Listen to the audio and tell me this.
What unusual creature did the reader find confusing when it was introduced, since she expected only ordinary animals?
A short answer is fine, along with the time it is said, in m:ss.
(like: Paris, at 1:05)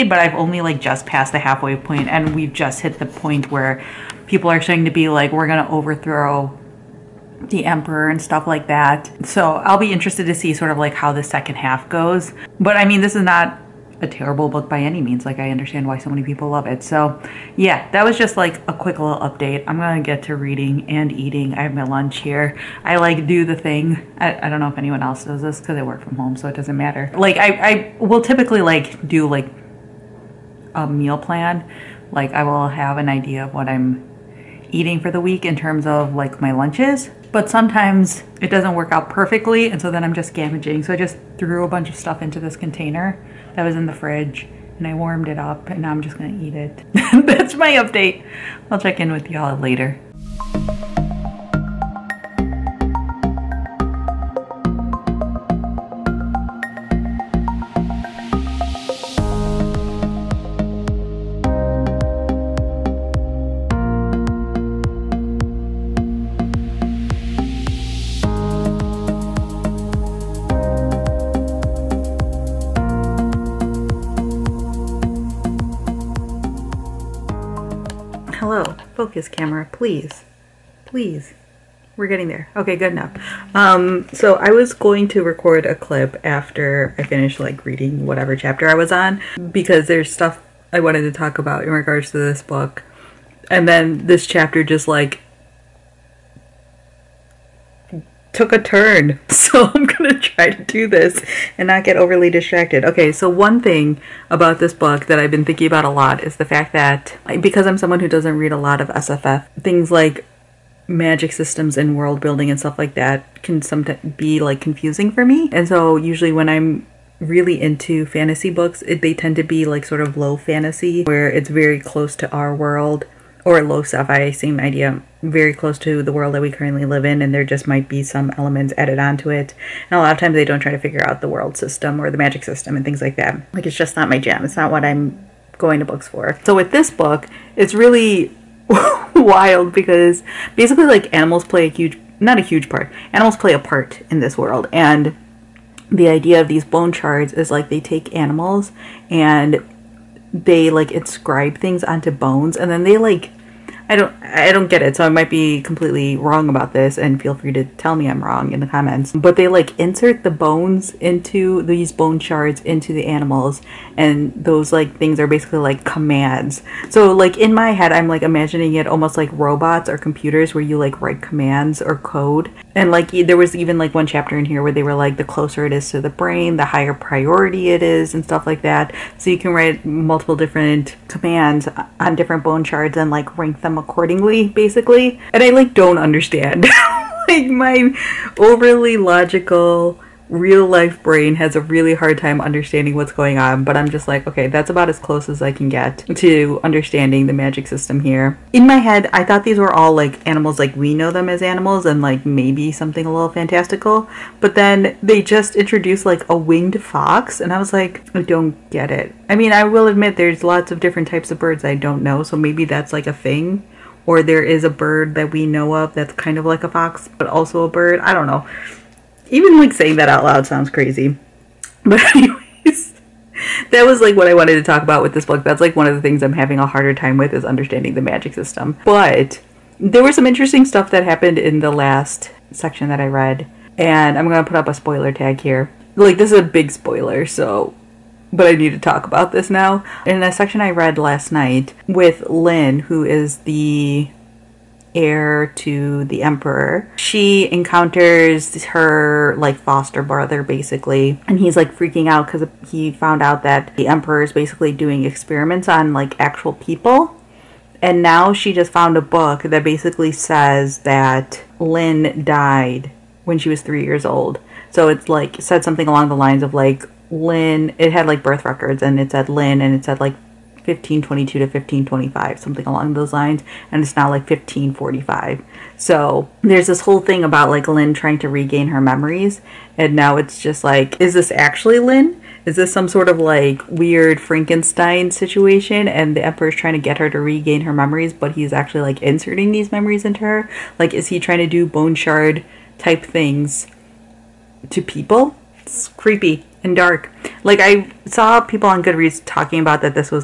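winged fox, at 3:26.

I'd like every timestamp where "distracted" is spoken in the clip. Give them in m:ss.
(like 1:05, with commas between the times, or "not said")
1:42.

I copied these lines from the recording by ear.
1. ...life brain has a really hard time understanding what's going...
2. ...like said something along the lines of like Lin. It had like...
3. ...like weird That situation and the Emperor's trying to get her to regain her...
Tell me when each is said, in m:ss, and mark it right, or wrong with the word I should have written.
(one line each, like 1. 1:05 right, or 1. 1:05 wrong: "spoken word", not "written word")
1. 3:10 right
2. 4:25 right
3. 4:43 wrong: "Frankenstein", not "That".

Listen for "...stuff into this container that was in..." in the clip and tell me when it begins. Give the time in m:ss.
0:41.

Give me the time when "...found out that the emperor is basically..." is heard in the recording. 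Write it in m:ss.
4:12.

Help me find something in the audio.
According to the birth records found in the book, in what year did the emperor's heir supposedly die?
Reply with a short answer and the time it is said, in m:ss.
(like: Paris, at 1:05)
1525, at 4:31.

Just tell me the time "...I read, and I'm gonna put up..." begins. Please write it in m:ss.
3:53.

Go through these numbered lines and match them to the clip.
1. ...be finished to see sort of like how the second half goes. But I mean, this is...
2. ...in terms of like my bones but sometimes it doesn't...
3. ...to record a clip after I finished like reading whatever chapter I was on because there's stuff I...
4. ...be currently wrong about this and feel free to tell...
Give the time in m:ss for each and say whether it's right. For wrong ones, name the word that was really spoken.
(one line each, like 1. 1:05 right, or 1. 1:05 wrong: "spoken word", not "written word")
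1. 0:09 wrong: "interested", not "finished"
2. 0:35 wrong: "lunches", not "bones"
3. 1:25 right
4. 2:35 wrong: "completely", not "currently".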